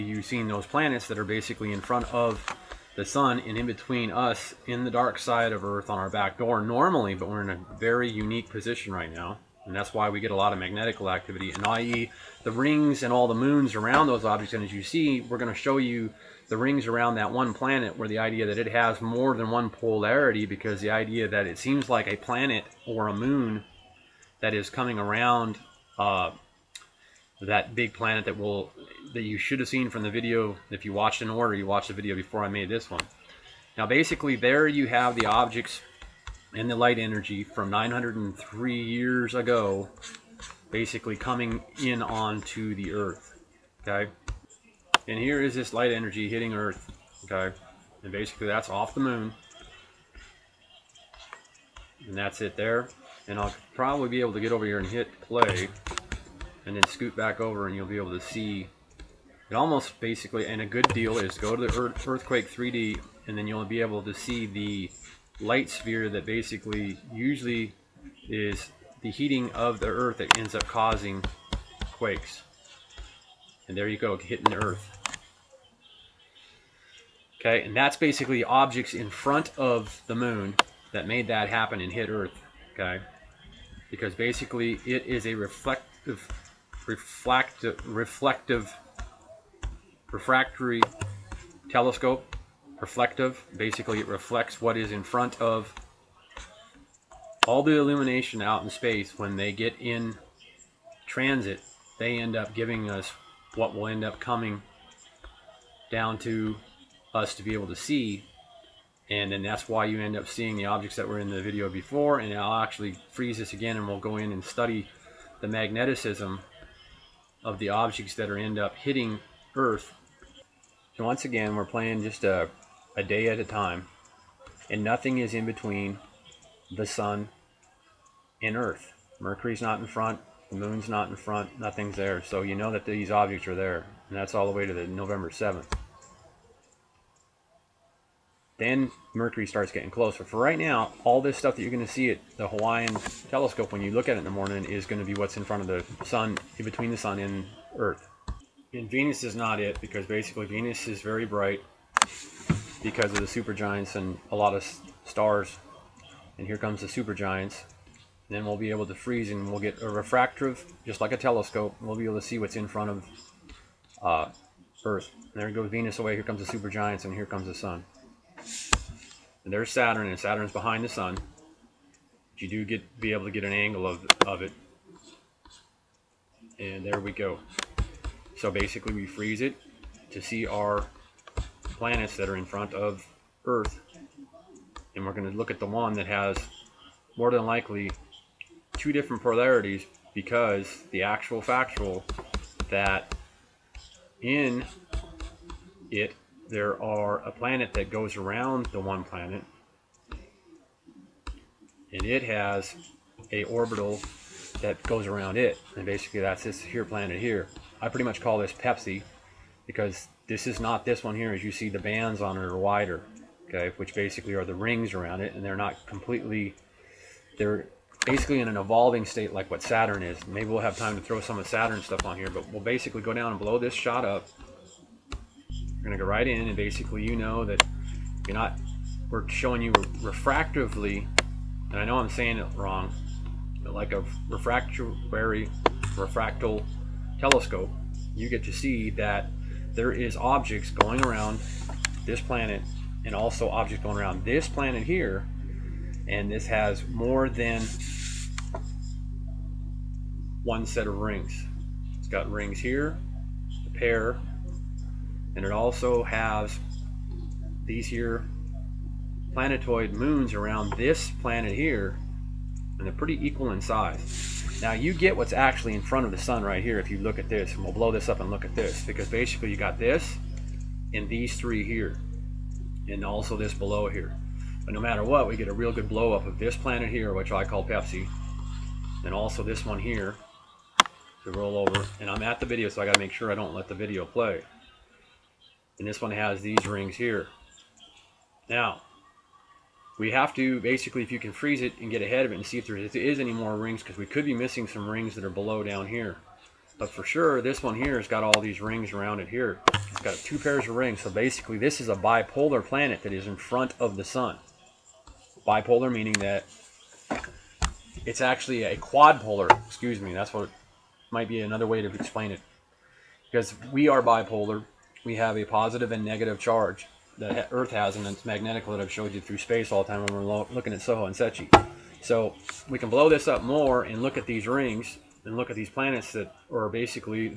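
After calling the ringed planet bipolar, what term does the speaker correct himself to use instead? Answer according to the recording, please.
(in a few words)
quadpolar.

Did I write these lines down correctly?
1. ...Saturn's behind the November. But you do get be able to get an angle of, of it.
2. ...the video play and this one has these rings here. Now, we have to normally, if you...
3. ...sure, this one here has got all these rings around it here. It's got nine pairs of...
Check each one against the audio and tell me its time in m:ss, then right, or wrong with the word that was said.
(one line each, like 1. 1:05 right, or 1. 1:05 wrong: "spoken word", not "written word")
1. 2:50 wrong: "Sun", not "November"
2. 4:43 wrong: "basically", not "normally"
3. 4:57 wrong: "two", not "nine".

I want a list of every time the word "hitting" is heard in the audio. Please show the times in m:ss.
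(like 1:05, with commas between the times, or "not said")
0:46, 1:14, 1:58.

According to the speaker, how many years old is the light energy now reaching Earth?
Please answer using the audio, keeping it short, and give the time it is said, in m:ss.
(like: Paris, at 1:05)
903 years, at 0:37.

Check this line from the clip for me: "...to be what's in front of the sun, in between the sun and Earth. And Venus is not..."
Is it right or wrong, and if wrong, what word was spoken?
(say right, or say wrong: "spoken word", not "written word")
right.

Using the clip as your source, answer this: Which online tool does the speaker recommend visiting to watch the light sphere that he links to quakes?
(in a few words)
earthquake 3d.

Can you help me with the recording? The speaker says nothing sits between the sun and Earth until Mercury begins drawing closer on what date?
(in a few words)
November 7th.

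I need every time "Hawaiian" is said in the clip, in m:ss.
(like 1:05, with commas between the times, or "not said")
2:22.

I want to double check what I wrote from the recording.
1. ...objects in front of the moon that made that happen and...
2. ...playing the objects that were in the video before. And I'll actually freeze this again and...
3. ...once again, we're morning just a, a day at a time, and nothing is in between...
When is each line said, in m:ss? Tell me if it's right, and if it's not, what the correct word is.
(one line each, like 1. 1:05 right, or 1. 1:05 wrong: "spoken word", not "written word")
1. 1:18 right
2. 1:50 wrong: "seeing", not "playing"
3. 2:01 wrong: "playing", not "morning".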